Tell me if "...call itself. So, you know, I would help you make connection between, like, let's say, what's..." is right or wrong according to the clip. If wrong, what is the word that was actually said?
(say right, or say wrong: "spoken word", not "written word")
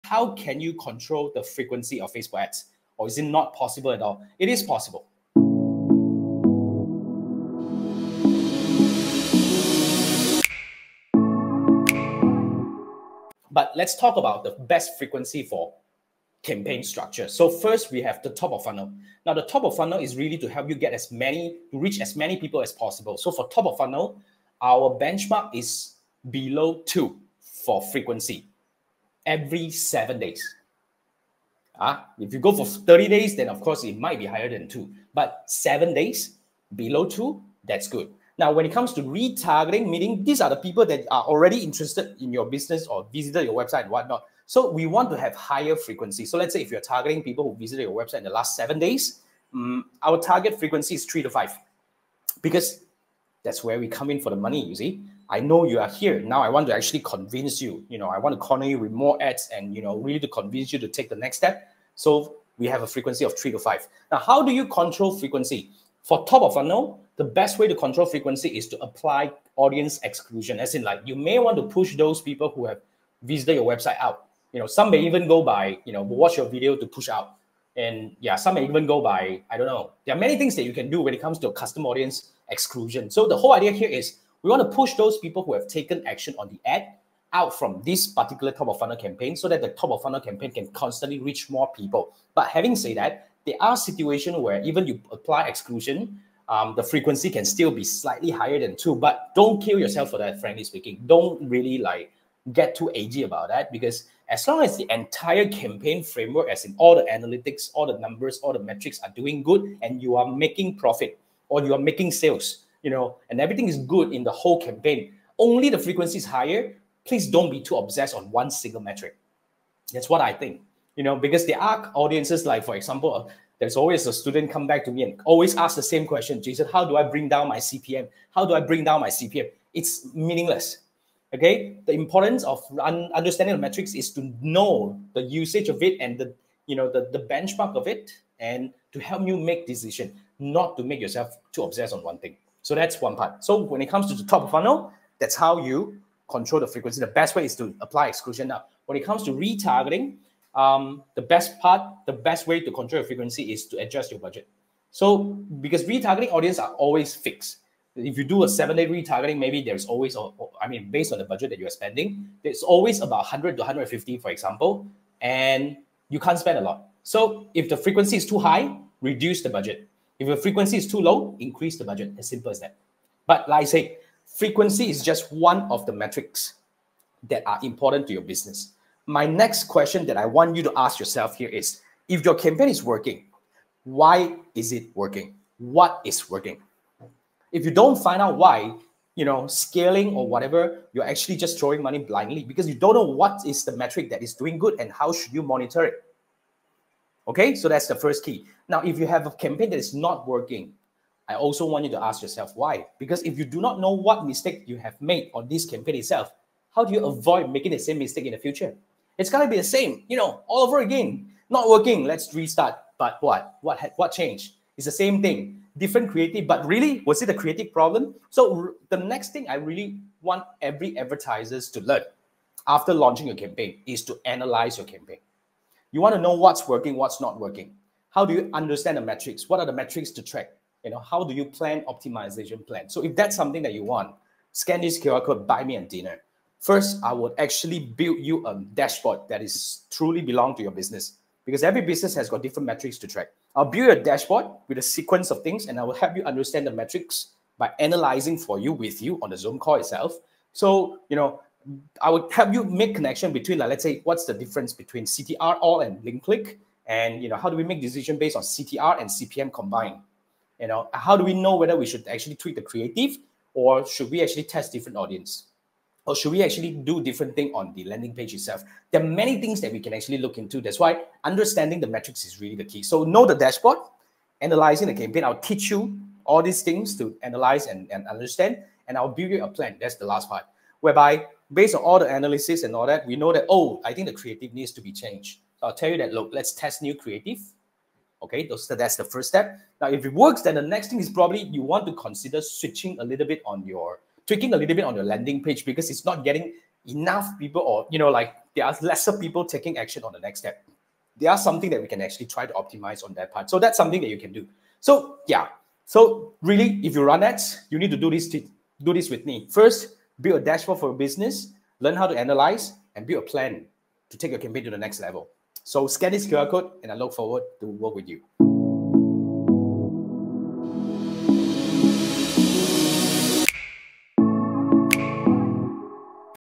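right.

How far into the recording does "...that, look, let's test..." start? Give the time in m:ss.
4:45.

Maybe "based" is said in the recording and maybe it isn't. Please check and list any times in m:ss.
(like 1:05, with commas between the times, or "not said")
2:40, 4:18, 4:41.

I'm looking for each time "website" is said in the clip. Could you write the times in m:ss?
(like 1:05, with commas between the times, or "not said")
0:43, 0:47, 1:13.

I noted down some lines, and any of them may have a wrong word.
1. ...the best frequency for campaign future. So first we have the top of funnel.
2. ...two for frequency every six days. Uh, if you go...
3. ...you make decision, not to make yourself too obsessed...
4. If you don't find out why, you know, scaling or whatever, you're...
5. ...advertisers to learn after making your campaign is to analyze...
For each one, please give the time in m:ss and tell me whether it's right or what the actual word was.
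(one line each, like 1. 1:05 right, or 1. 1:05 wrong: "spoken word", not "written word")
1. 0:14 wrong: "structure", not "future"
2. 0:26 wrong: "seven", not "six"
3. 2:19 right
4. 3:07 right
5. 3:40 wrong: "launching", not "making".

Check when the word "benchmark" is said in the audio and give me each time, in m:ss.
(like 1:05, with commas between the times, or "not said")
0:24, 2:17.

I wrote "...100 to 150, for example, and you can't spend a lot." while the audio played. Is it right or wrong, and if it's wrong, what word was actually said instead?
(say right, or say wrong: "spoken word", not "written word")
right.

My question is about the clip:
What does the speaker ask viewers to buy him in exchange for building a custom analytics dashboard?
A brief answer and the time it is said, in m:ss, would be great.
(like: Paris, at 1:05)
dinner, at 3:55.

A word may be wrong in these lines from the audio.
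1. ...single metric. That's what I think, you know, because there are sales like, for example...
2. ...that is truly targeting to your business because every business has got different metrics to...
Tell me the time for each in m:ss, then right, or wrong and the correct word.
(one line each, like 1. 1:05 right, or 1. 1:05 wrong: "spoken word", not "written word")
1. 1:58 wrong: "audiences", not "sales"
2. 3:59 wrong: "belong", not "targeting".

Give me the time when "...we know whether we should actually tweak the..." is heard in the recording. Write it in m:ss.
4:21.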